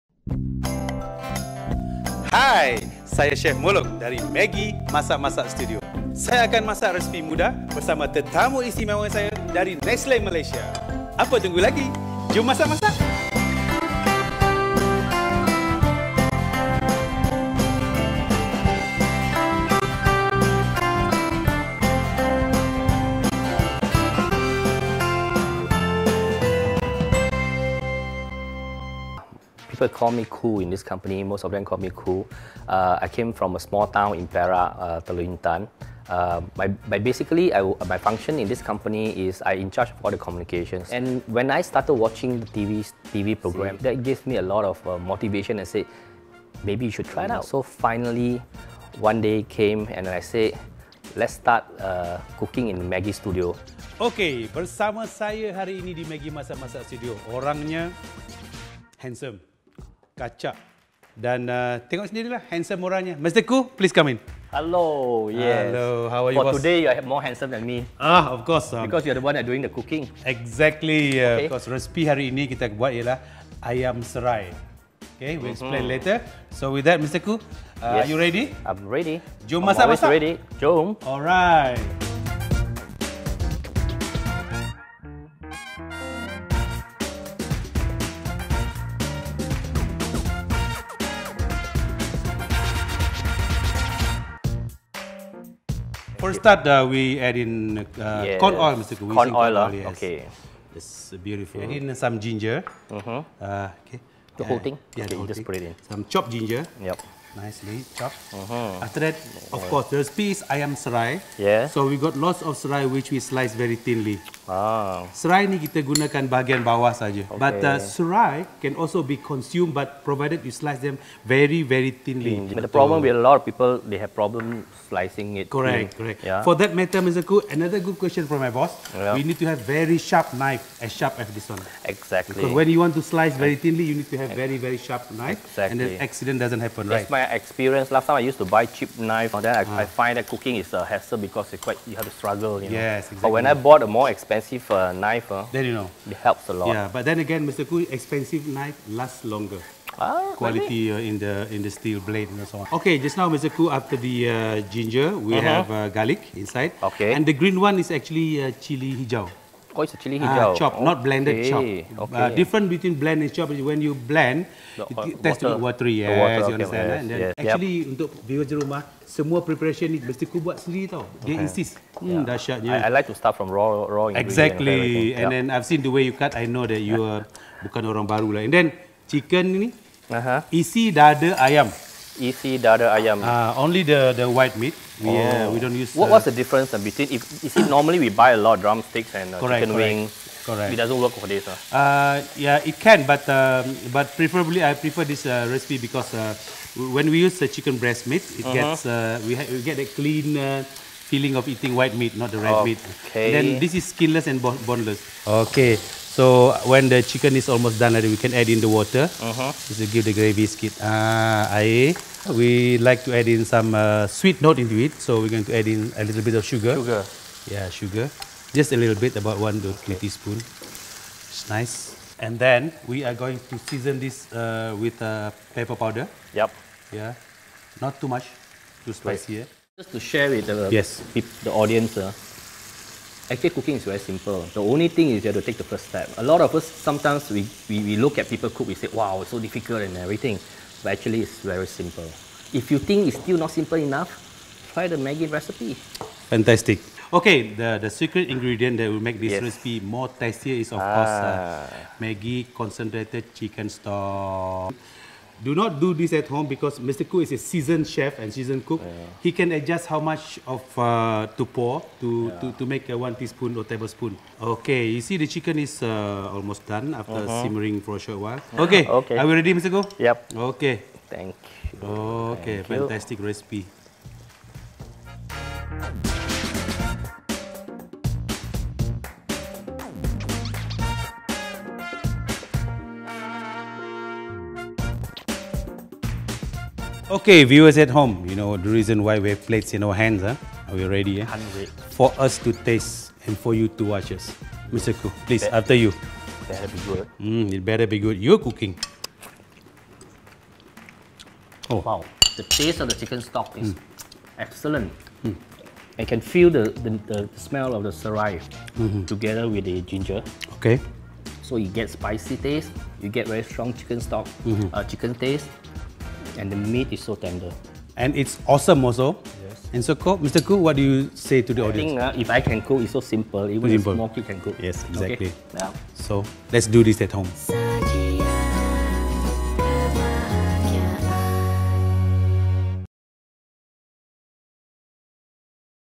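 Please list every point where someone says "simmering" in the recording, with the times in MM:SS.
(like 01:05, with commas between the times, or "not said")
04:27.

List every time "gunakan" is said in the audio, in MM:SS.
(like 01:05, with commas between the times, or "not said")
01:55.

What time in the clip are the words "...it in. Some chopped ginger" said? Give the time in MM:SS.
01:45.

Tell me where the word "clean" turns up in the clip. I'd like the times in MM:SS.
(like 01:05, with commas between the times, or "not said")
03:19.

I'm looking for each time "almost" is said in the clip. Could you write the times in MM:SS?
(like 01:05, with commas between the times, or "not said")
03:27, 04:26.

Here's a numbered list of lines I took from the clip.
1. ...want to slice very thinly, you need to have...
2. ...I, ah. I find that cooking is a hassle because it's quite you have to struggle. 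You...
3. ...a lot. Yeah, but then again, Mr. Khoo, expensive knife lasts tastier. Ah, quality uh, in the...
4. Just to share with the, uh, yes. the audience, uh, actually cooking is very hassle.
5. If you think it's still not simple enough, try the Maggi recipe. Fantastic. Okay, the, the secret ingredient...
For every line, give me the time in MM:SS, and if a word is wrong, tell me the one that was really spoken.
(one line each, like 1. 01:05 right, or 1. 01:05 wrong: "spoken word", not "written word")
1. 02:12 right
2. 02:19 right
3. 02:26 wrong: "longer", not "tastier"
4. 03:49 wrong: "simple", not "hassle"
5. 04:02 right.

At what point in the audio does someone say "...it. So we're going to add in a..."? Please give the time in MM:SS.
03:34.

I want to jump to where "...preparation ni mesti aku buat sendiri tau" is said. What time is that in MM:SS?
02:49.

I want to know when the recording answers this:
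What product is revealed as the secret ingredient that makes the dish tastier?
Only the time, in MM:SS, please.
04:12.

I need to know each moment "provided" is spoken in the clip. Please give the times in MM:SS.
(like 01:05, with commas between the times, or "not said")
02:00.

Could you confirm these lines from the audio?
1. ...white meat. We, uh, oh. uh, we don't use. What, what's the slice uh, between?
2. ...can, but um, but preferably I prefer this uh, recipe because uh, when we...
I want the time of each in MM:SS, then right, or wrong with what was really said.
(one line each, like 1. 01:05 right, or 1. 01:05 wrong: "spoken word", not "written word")
1. 03:04 wrong: "difference", not "slice"
2. 03:12 right.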